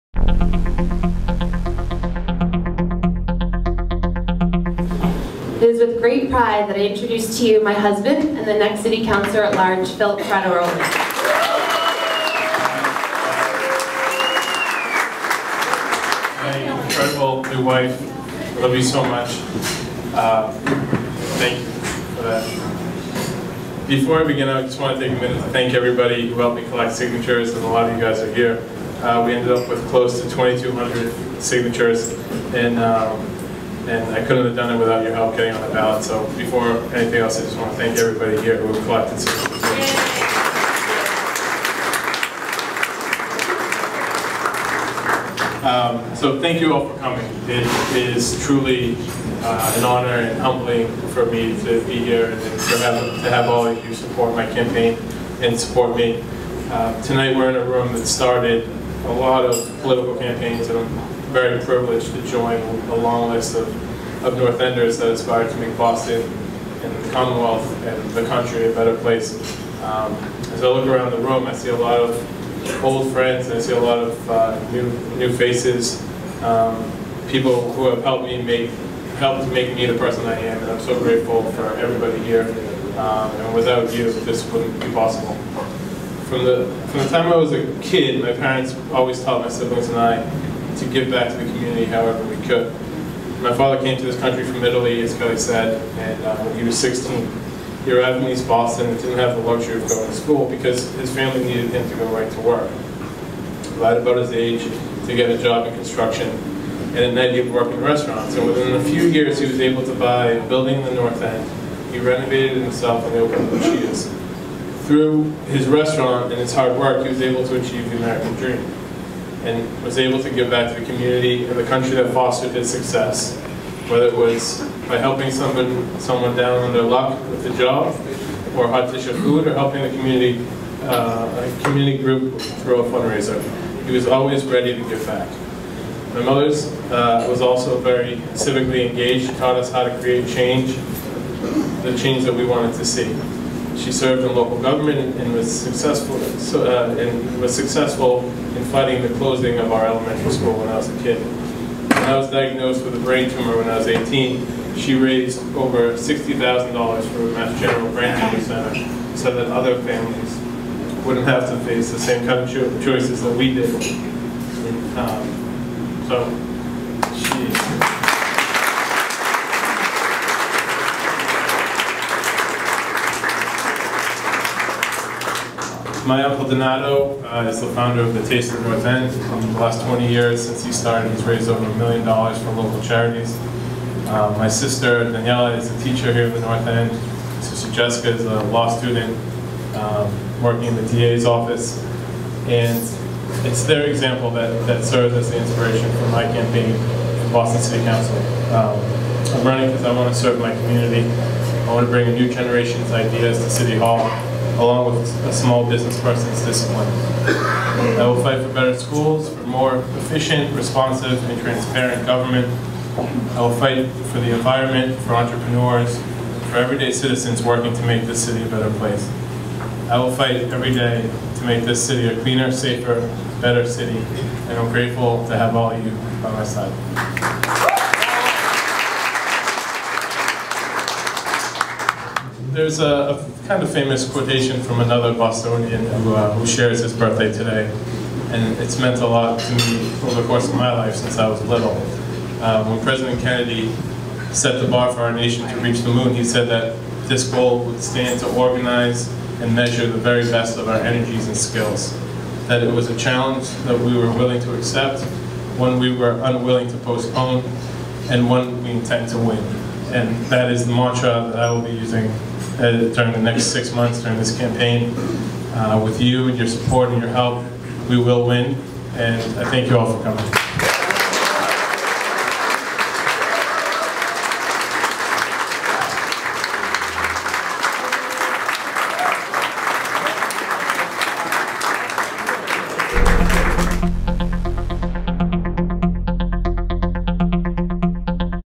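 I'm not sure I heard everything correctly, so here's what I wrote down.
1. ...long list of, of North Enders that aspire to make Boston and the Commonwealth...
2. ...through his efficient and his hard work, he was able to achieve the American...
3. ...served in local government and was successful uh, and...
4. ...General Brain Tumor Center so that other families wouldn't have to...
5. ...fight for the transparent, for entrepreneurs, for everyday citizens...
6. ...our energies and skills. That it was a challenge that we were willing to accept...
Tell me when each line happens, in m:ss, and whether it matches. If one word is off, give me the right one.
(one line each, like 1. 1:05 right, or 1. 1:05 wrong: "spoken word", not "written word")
1. 1:02 right
2. 1:54 wrong: "restaurant", not "efficient"
3. 2:23 right
4. 2:37 right
5. 3:33 wrong: "environment", not "transparent"
6. 4:10 right.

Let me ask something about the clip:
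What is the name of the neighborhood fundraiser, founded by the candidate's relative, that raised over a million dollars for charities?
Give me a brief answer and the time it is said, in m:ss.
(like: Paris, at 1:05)
Taste of North End, at 2:58.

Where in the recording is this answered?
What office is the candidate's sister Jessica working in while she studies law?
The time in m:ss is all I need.
3:10.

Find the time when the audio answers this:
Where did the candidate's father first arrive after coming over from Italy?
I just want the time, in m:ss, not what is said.
1:38.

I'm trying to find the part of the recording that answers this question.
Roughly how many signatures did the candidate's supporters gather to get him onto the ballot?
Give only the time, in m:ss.
0:30.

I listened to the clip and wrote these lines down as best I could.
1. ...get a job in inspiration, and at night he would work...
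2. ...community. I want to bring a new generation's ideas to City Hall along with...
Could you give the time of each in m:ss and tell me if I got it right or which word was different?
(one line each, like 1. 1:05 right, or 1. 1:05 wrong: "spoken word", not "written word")
1. 1:45 wrong: "construction", not "inspiration"
2. 3:20 right.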